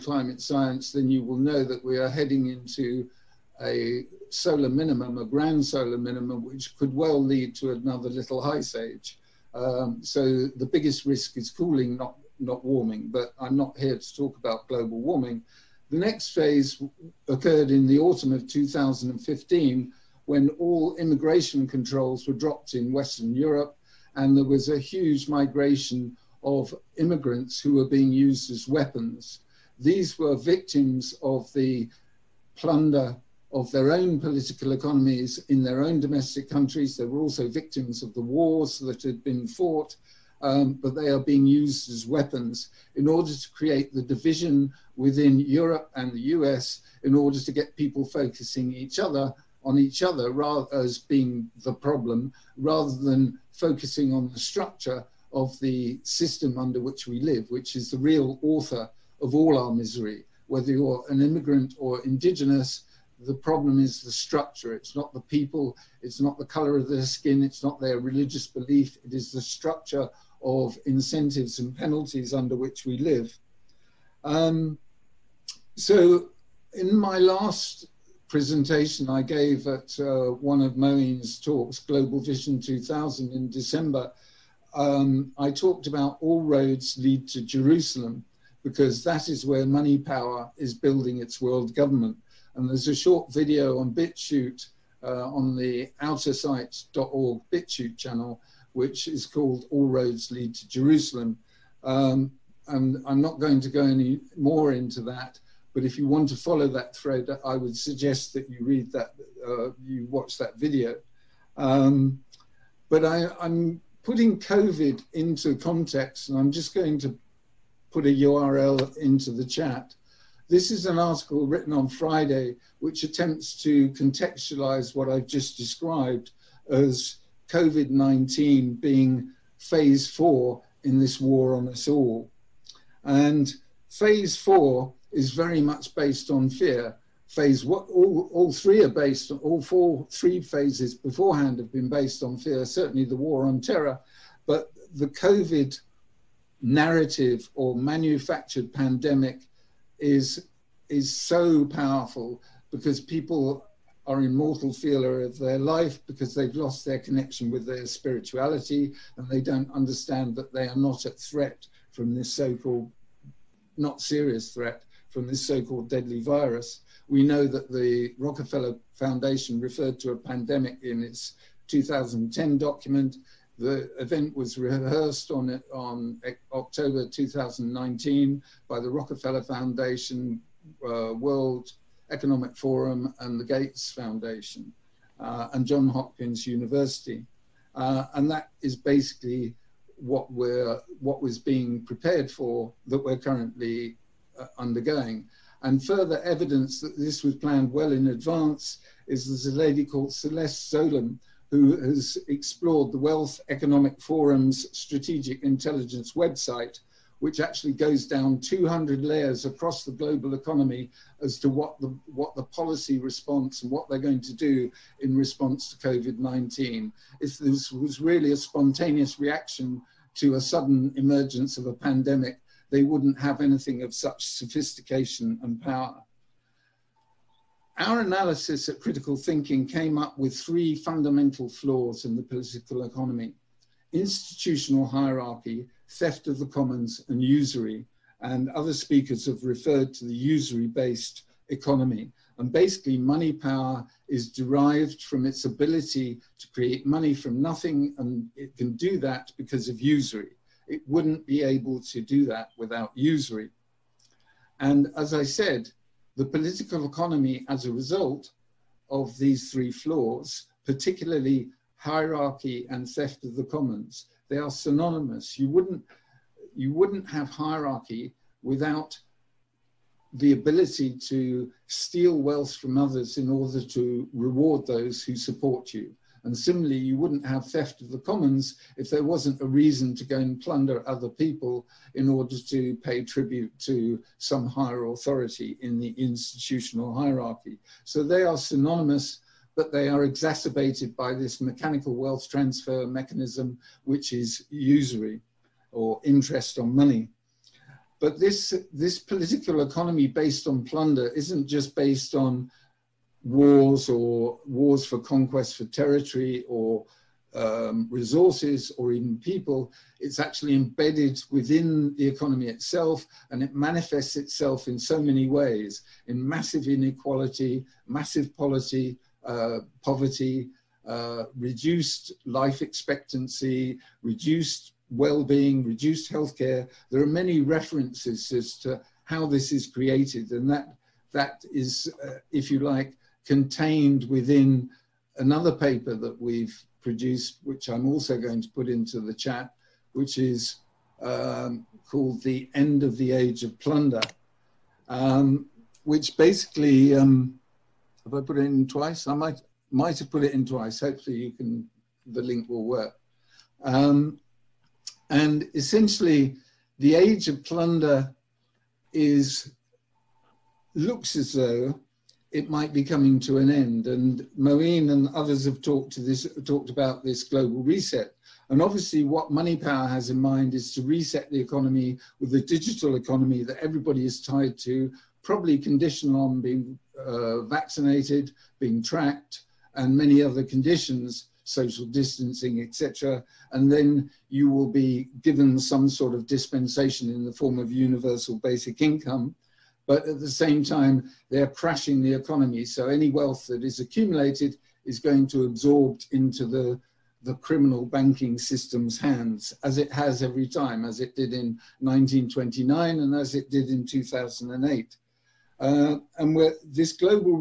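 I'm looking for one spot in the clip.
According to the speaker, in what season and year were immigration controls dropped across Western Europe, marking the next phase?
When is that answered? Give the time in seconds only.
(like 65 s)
17 s.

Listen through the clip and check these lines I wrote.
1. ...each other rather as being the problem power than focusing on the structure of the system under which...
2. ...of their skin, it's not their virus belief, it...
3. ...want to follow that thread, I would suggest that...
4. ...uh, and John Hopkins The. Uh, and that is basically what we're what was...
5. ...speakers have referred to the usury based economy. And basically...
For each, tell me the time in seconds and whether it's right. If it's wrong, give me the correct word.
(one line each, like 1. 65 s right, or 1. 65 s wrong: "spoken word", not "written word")
1. 49 s wrong: "rather", not "power"
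2. 66 s wrong: "religious", not "virus"
3. 106 s right
4. 185 s wrong: "University", not "The"
5. 238 s right.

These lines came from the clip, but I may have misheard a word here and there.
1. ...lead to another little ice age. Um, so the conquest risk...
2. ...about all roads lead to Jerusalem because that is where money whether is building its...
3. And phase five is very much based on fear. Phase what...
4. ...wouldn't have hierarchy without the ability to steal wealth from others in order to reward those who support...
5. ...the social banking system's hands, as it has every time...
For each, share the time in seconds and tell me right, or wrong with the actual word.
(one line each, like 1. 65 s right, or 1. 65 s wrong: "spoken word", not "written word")
1. 7 s wrong: "biggest", not "conquest"
2. 85 s wrong: "power", not "whether"
3. 133 s wrong: "four", not "five"
4. 266 s right
5. 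397 s wrong: "criminal", not "social".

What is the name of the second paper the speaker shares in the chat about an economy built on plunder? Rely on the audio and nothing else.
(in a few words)
The End of the Age of Plunder.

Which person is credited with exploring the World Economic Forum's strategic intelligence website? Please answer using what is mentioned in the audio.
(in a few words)
Celeste Solum.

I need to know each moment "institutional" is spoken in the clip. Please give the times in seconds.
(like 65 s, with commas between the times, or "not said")
233 s, 285 s.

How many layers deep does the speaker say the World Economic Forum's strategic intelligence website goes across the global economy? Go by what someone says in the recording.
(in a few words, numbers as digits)
200.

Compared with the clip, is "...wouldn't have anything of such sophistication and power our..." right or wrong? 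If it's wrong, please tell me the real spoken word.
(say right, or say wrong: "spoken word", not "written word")
right.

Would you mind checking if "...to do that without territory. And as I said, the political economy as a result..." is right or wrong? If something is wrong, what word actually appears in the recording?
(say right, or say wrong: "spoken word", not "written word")
wrong: "usury", not "territory".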